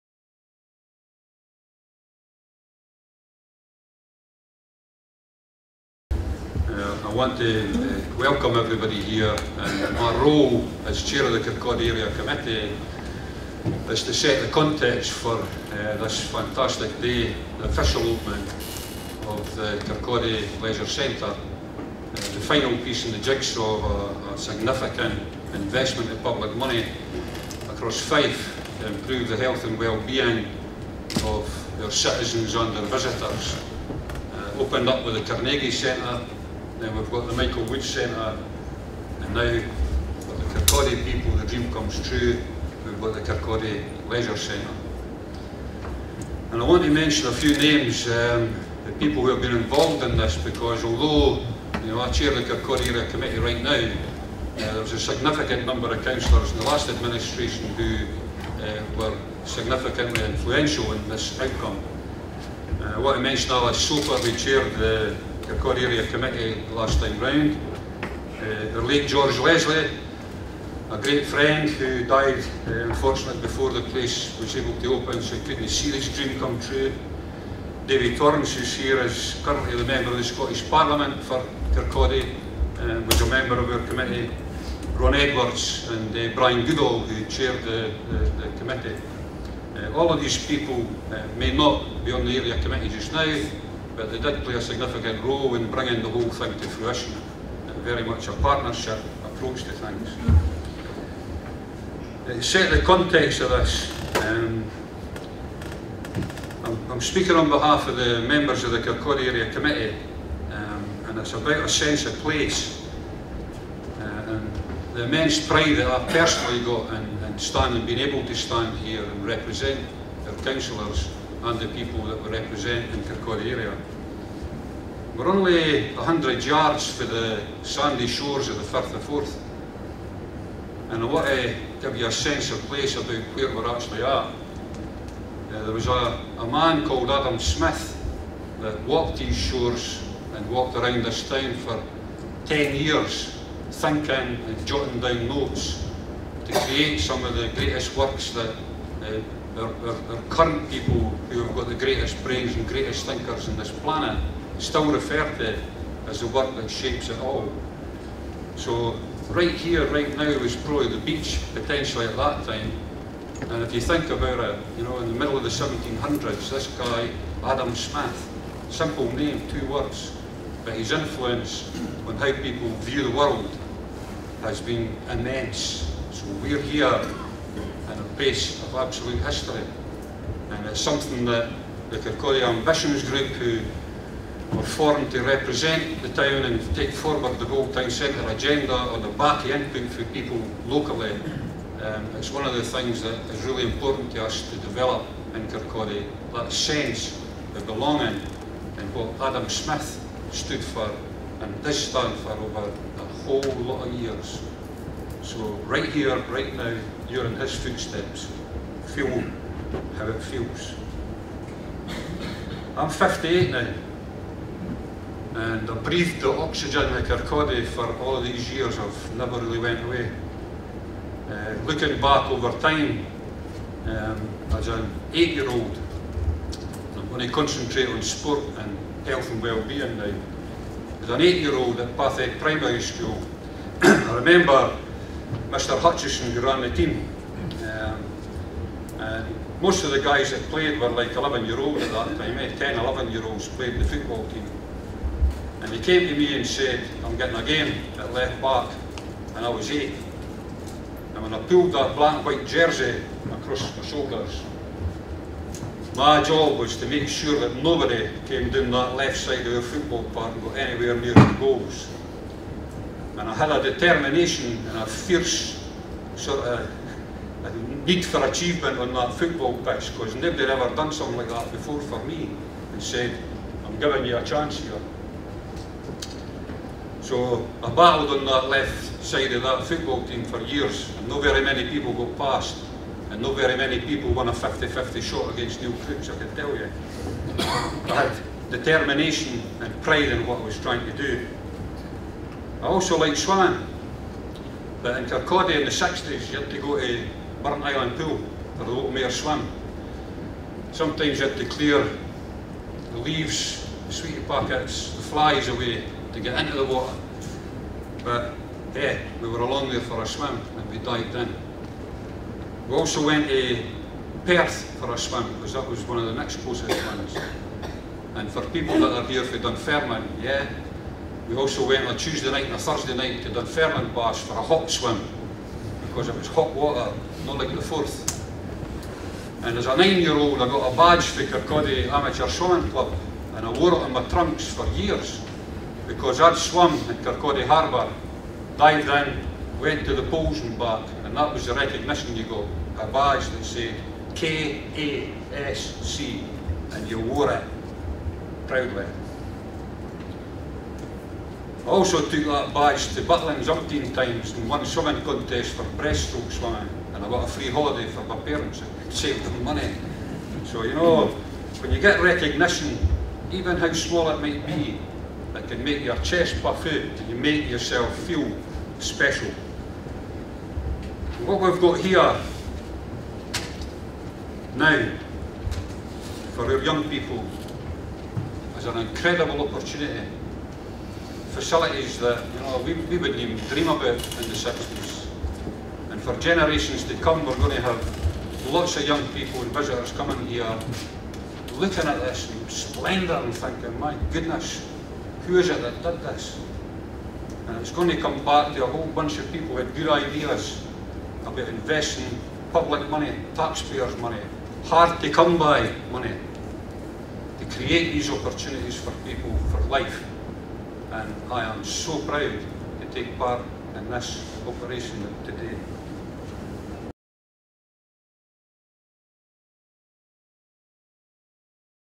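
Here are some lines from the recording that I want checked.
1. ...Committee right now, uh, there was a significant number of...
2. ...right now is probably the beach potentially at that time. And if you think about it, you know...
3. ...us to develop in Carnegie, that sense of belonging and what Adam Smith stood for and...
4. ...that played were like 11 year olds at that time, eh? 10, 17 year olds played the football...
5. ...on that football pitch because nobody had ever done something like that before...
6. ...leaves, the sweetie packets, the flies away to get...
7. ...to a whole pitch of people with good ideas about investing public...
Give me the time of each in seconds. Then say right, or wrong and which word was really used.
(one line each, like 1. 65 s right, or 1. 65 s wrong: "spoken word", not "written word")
1. 53 s right
2. 159 s right
3. 194 s wrong: "Kirkcaldy", not "Carnegie"
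4. 240 s wrong: "11", not "17"
5. 268 s right
6. 302 s right
7. 398 s wrong: "bunch", not "pitch".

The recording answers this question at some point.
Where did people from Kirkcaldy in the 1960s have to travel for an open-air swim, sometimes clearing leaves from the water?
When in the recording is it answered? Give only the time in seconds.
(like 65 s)
297 s.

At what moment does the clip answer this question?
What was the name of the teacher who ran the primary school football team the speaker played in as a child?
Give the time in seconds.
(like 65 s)
235 s.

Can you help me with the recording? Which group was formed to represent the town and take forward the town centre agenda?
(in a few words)
Kirkcaldy Ambitions Group.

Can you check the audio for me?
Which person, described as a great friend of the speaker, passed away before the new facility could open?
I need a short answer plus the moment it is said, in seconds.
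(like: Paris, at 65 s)
George Leslie, at 69 s.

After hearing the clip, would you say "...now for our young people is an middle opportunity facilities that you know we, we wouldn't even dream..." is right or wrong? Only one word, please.
wrong.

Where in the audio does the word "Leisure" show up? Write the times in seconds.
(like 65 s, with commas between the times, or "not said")
20 s, 44 s.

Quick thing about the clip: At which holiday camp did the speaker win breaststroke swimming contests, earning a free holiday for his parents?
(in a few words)
Butlins.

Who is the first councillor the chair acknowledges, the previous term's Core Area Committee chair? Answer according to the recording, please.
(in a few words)
Alice Soper.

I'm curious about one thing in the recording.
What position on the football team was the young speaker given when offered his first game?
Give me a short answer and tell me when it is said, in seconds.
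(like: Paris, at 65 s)
left back, at 248 s.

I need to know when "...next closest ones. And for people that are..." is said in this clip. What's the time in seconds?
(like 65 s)
316 s.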